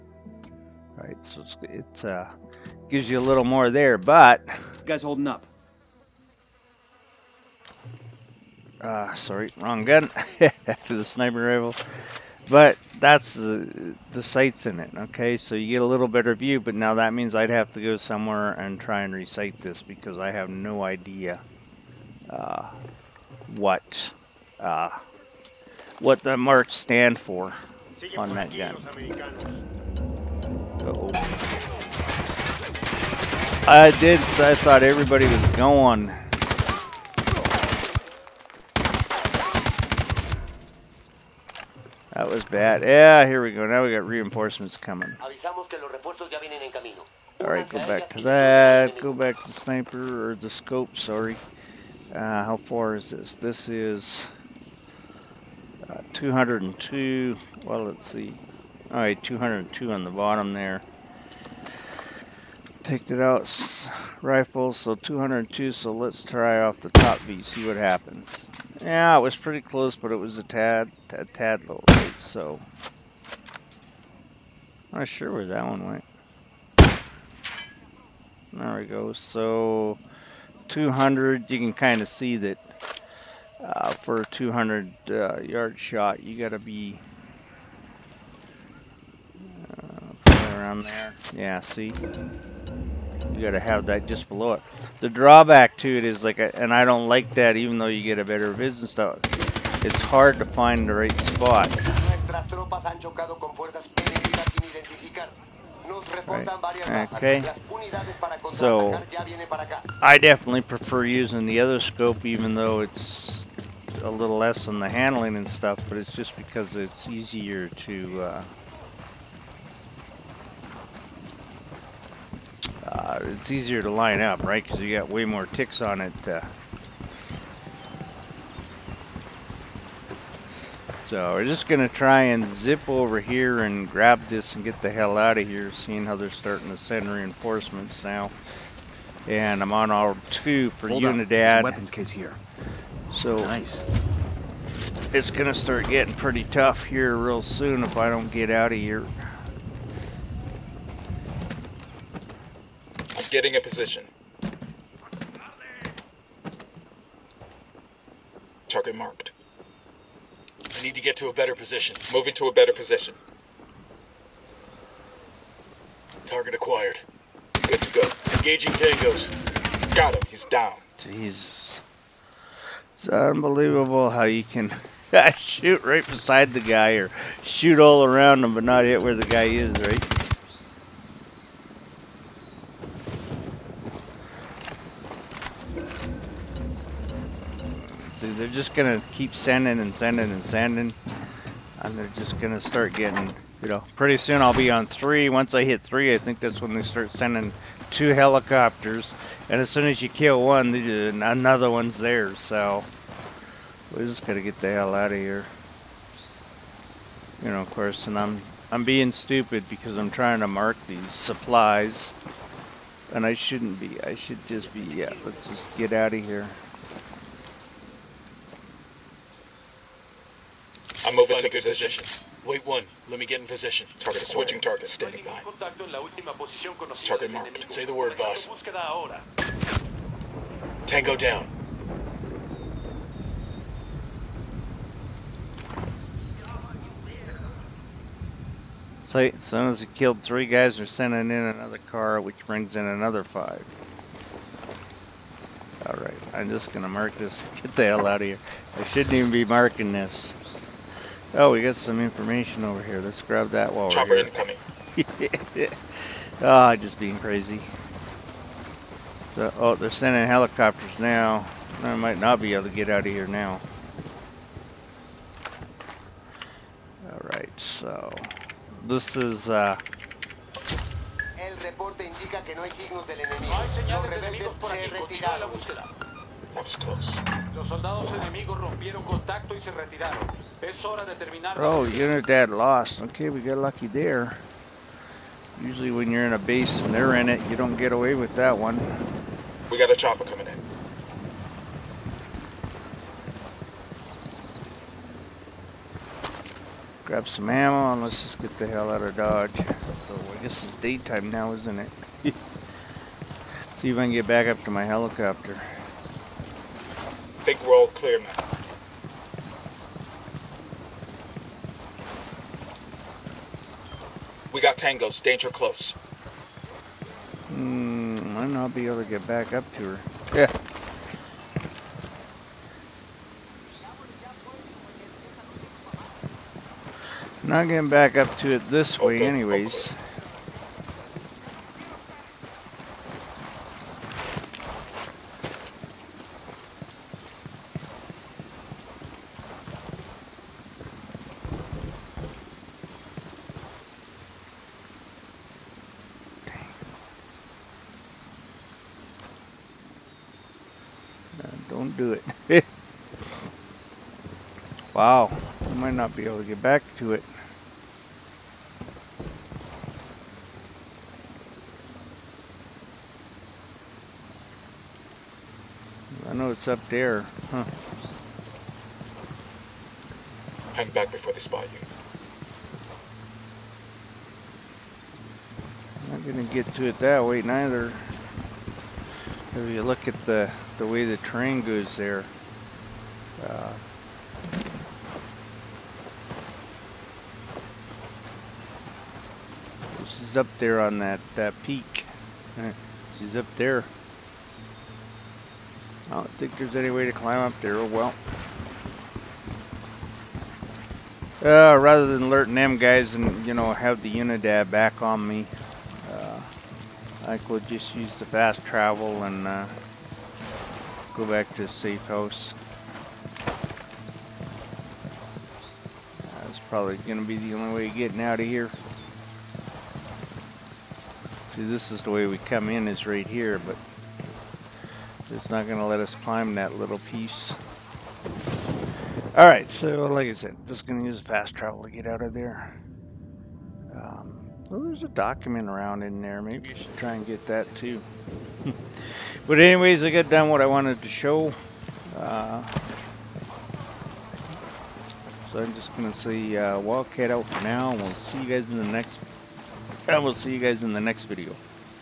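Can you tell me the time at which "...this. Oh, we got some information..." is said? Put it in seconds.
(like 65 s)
249 s.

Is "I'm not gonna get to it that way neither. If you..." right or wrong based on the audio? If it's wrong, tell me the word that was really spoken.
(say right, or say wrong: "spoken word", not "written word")
right.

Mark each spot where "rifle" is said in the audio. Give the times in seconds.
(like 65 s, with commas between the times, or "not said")
11 s, 64 s.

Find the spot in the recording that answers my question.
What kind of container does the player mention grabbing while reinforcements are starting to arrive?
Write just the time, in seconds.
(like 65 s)
141 s.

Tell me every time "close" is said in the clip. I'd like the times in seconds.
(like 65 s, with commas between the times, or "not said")
69 s, 276 s, 315 s.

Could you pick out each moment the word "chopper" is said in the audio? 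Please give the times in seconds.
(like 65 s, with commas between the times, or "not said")
253 s, 289 s.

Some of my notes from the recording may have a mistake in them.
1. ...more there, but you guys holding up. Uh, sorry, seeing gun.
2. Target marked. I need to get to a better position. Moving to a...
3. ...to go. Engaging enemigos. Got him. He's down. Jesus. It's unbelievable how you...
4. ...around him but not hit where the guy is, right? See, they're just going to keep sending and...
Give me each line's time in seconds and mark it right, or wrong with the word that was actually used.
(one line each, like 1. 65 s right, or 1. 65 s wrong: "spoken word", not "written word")
1. 3 s wrong: "wrong", not "seeing"
2. 158 s right
3. 167 s wrong: "tangos", not "enemigos"
4. 178 s right.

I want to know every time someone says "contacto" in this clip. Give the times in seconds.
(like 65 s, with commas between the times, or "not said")
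279 s.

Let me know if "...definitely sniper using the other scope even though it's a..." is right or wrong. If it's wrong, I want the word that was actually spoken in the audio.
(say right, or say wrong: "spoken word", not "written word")
wrong: "prefer", not "sniper".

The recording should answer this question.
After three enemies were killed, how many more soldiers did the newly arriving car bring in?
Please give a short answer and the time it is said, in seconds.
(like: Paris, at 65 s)
5, at 243 s.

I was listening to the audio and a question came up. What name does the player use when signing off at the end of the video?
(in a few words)
Wildcat.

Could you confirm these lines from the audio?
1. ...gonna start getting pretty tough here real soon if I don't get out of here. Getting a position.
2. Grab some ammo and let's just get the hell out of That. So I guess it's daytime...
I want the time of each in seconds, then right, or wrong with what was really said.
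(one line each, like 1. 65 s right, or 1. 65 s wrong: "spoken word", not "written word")
1. 145 s right
2. 297 s wrong: "Dodge", not "That".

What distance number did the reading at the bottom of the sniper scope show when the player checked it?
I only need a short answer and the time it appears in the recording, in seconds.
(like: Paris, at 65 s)
202, at 59 s.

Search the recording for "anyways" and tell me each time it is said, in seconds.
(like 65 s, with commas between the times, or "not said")
329 s, 439 s.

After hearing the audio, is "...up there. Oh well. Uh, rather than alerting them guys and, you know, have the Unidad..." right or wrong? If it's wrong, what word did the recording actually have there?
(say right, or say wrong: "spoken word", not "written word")
right.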